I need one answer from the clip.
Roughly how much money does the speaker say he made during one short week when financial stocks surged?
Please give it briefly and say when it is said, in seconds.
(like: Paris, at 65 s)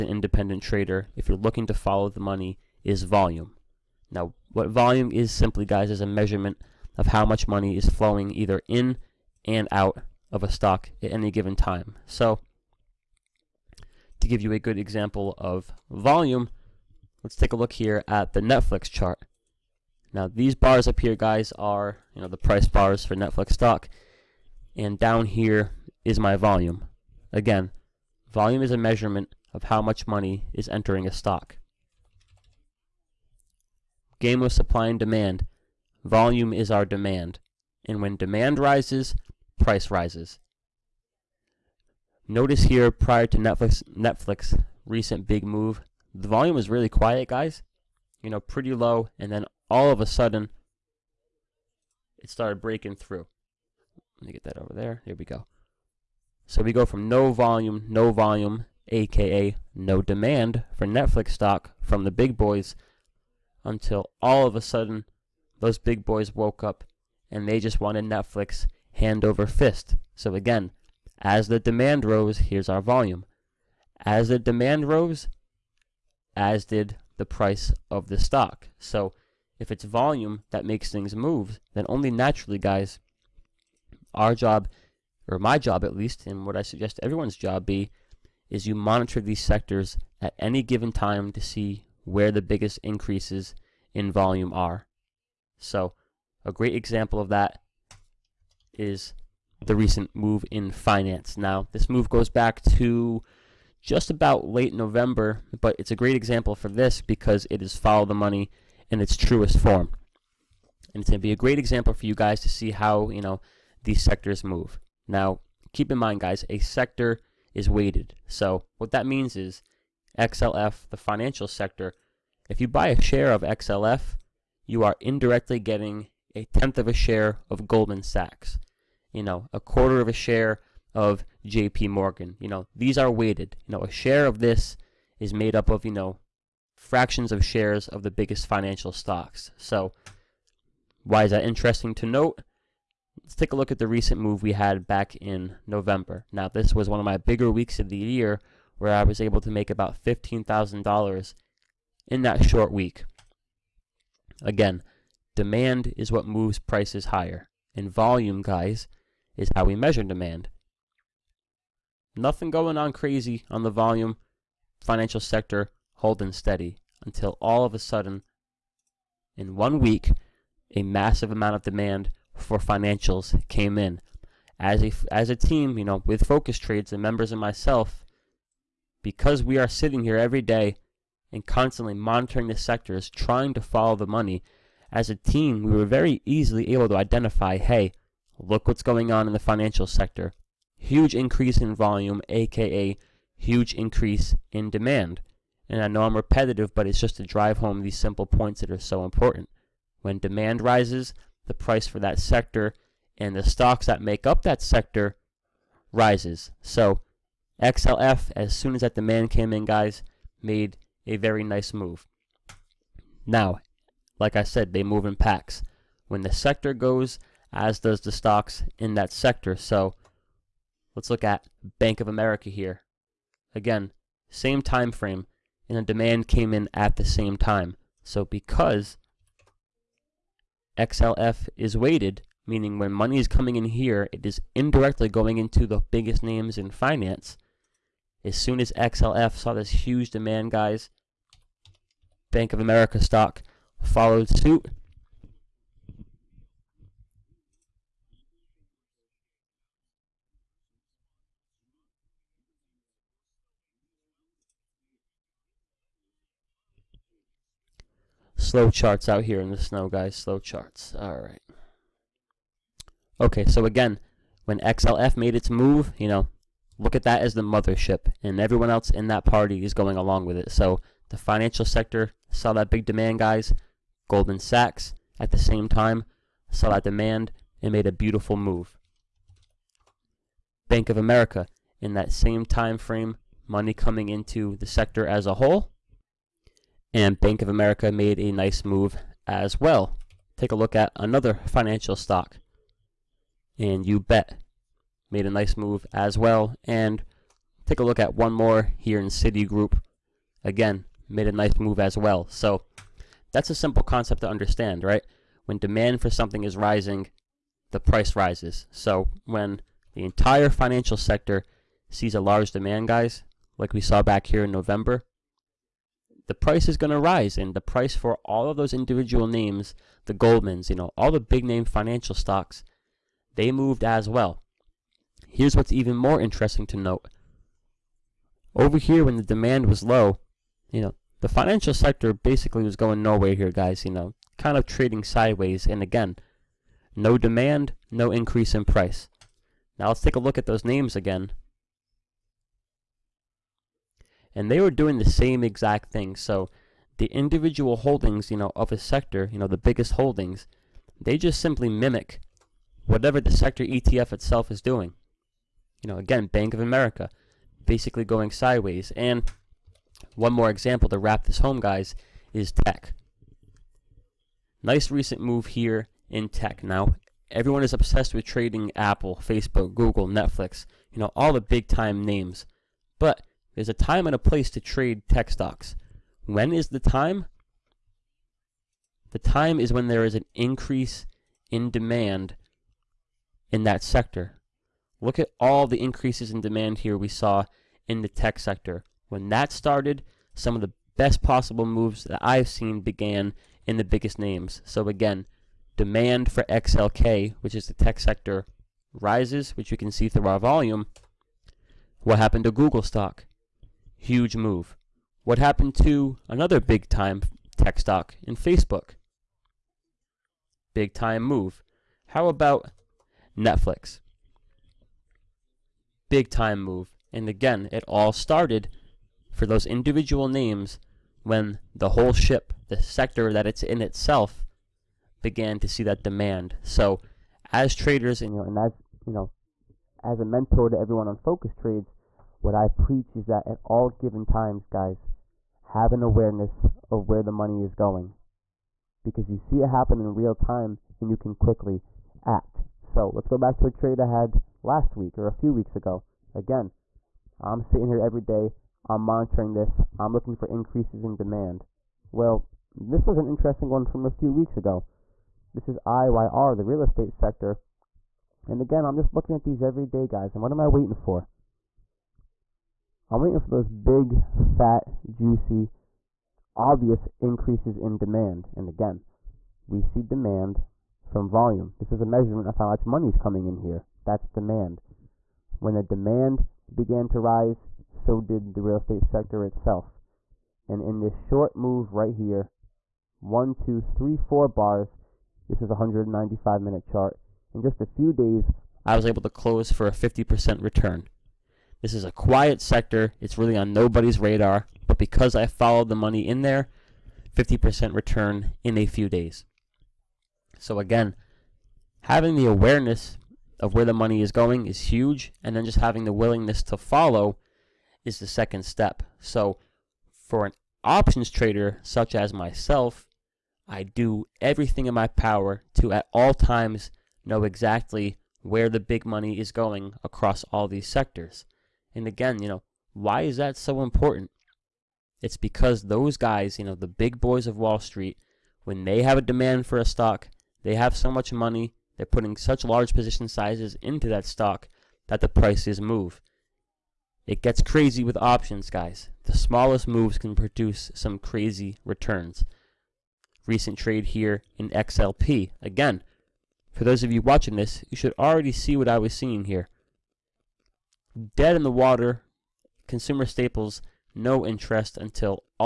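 $15,000, at 150 s.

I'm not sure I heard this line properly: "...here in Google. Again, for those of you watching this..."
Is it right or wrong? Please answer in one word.
wrong.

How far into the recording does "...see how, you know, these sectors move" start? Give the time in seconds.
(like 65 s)
112 s.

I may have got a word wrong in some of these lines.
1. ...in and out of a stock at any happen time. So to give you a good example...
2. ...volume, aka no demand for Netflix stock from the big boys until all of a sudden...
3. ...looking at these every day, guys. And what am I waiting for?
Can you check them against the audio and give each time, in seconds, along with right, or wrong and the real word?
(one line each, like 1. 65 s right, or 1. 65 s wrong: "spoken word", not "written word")
1. 8 s wrong: "given", not "happen"
2. 58 s right
3. 459 s right.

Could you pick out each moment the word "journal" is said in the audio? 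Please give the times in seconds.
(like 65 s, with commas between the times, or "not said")
not said.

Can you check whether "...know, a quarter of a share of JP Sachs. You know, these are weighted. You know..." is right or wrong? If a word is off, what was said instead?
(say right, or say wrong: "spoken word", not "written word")
wrong: "Morgan", not "Sachs".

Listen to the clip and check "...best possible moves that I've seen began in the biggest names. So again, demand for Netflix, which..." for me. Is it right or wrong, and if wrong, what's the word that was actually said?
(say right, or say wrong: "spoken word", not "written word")
wrong: "XLK", not "Netflix".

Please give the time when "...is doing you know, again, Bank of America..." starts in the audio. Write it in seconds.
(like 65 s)
354 s.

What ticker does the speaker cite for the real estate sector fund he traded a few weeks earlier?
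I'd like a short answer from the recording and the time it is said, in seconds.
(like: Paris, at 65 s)
IYR, at 455 s.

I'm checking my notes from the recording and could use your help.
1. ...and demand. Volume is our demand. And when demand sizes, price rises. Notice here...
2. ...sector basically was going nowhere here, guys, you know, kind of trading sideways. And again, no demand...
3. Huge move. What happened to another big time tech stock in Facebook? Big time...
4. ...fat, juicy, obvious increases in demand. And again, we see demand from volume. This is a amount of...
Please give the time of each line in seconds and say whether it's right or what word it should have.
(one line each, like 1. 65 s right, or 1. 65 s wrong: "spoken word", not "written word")
1. 34 s wrong: "rises", not "sizes"
2. 331 s right
3. 403 s right
4. 464 s wrong: "measurement", not "amount".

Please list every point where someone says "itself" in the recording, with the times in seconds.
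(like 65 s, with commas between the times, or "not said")
354 s, 423 s, 479 s.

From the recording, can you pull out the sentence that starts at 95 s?
So a great example of that is the recent move in finance.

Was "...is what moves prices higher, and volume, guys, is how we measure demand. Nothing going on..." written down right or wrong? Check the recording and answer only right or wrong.
right.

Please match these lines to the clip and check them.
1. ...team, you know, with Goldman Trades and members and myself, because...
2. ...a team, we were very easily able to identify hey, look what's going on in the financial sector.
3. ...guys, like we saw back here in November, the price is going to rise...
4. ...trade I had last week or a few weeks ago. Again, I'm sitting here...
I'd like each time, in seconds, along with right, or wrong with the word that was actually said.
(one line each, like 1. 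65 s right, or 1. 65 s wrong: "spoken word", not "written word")
1. 175 s wrong: "Focused", not "Goldman"
2. 185 s right
3. 312 s right
4. 443 s right.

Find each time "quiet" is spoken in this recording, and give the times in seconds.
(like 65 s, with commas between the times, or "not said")
46 s, 492 s.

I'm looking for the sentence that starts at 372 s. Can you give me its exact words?
But there's a time and a place to trade tech stocks.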